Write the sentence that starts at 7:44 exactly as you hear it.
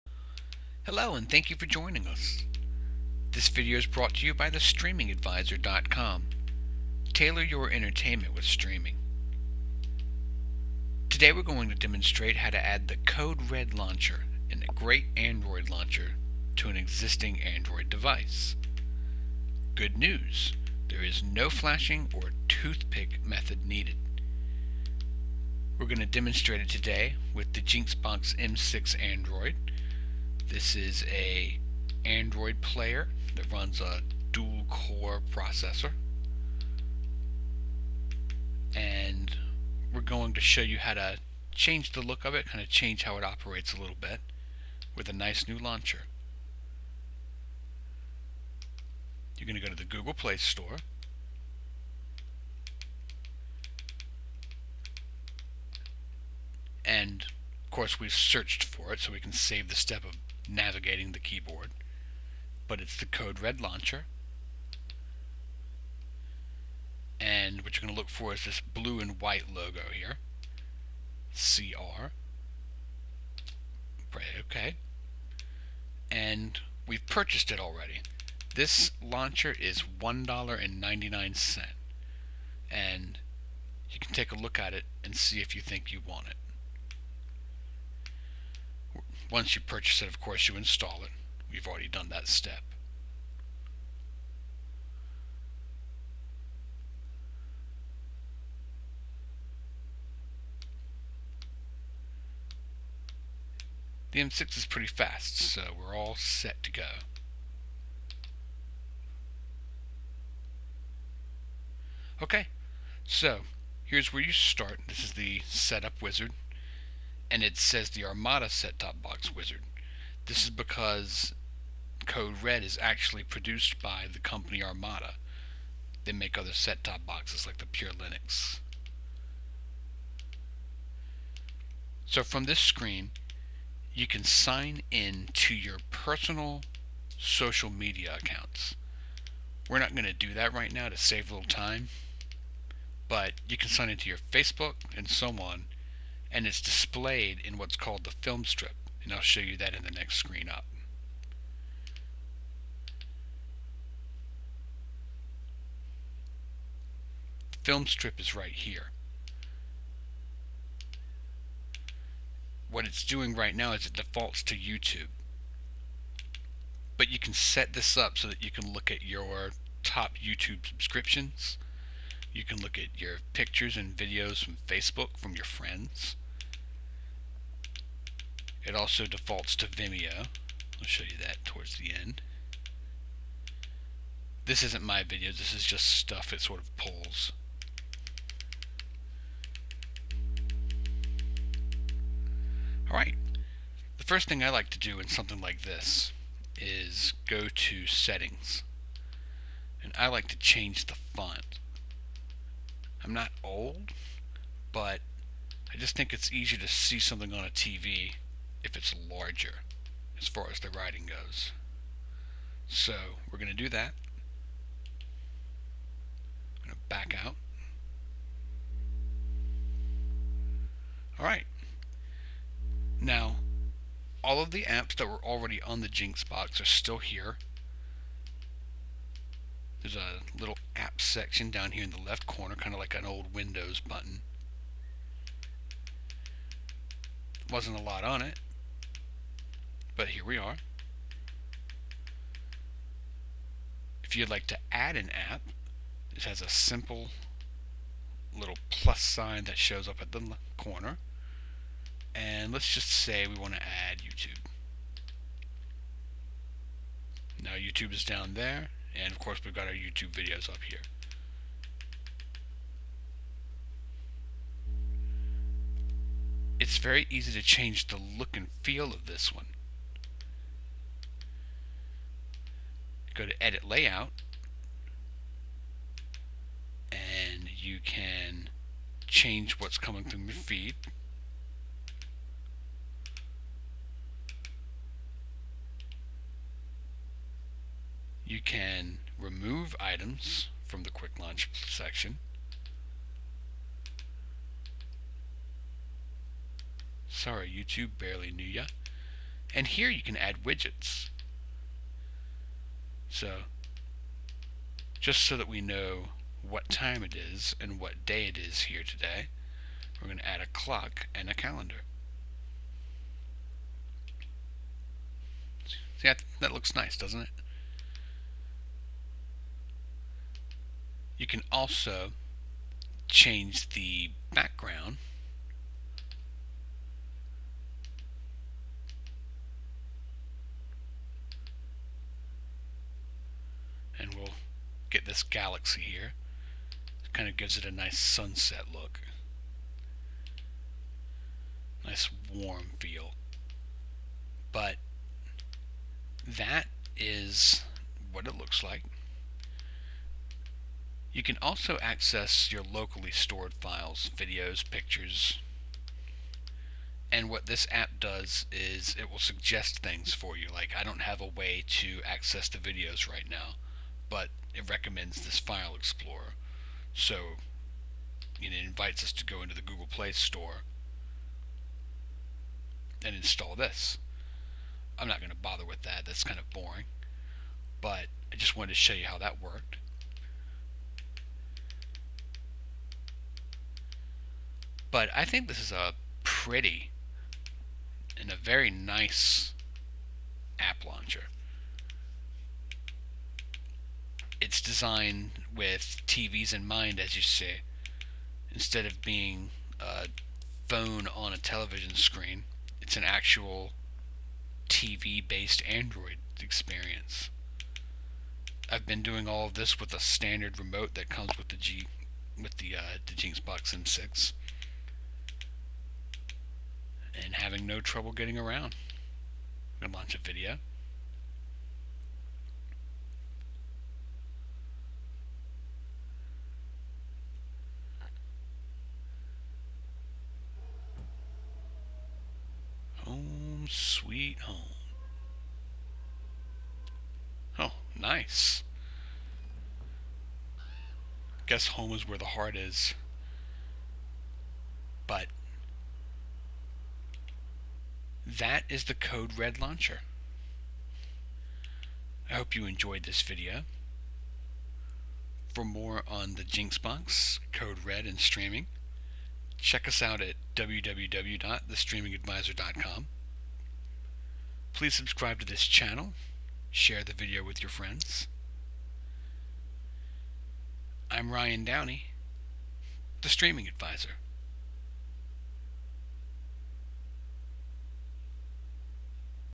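Please subscribe to this channel share the video with your friends.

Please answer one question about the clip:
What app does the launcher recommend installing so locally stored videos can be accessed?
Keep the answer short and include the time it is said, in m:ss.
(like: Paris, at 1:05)
File Explorer, at 6:05.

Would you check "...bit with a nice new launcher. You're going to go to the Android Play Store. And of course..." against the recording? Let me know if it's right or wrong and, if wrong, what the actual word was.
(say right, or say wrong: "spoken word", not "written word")
wrong: "Google", not "Android".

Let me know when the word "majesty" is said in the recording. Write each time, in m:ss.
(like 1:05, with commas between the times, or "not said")
not said.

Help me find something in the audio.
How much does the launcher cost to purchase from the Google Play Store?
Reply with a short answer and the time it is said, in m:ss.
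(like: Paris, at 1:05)
$1.99, at 1:20.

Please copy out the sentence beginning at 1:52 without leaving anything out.
Okay, so here's where you start.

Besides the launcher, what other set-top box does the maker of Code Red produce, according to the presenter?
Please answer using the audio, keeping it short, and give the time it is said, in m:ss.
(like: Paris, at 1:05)
Pure Linux, at 2:07.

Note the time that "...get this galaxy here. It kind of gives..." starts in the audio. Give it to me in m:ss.
5:34.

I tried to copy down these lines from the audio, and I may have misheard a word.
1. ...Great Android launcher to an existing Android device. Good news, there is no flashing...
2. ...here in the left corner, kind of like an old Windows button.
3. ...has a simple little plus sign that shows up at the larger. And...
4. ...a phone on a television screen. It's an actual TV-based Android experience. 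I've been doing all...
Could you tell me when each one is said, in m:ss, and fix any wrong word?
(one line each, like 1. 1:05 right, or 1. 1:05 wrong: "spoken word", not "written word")
1. 0:14 right
2. 3:51 right
3. 4:06 wrong: "corner", not "larger"
4. 6:39 right.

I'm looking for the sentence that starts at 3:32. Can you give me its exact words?
So we're going to do that.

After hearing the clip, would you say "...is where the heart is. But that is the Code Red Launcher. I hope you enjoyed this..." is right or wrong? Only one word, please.
right.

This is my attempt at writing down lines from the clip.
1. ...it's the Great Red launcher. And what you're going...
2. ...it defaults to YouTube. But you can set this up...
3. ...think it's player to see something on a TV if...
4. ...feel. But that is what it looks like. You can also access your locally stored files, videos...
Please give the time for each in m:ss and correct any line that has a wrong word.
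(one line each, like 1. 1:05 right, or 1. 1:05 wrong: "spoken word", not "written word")
1. 1:02 wrong: "Code", not "Great"
2. 2:43 right
3. 3:25 wrong: "easier", not "player"
4. 5:42 right.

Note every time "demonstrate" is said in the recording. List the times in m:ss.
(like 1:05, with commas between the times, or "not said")
0:11, 0:26.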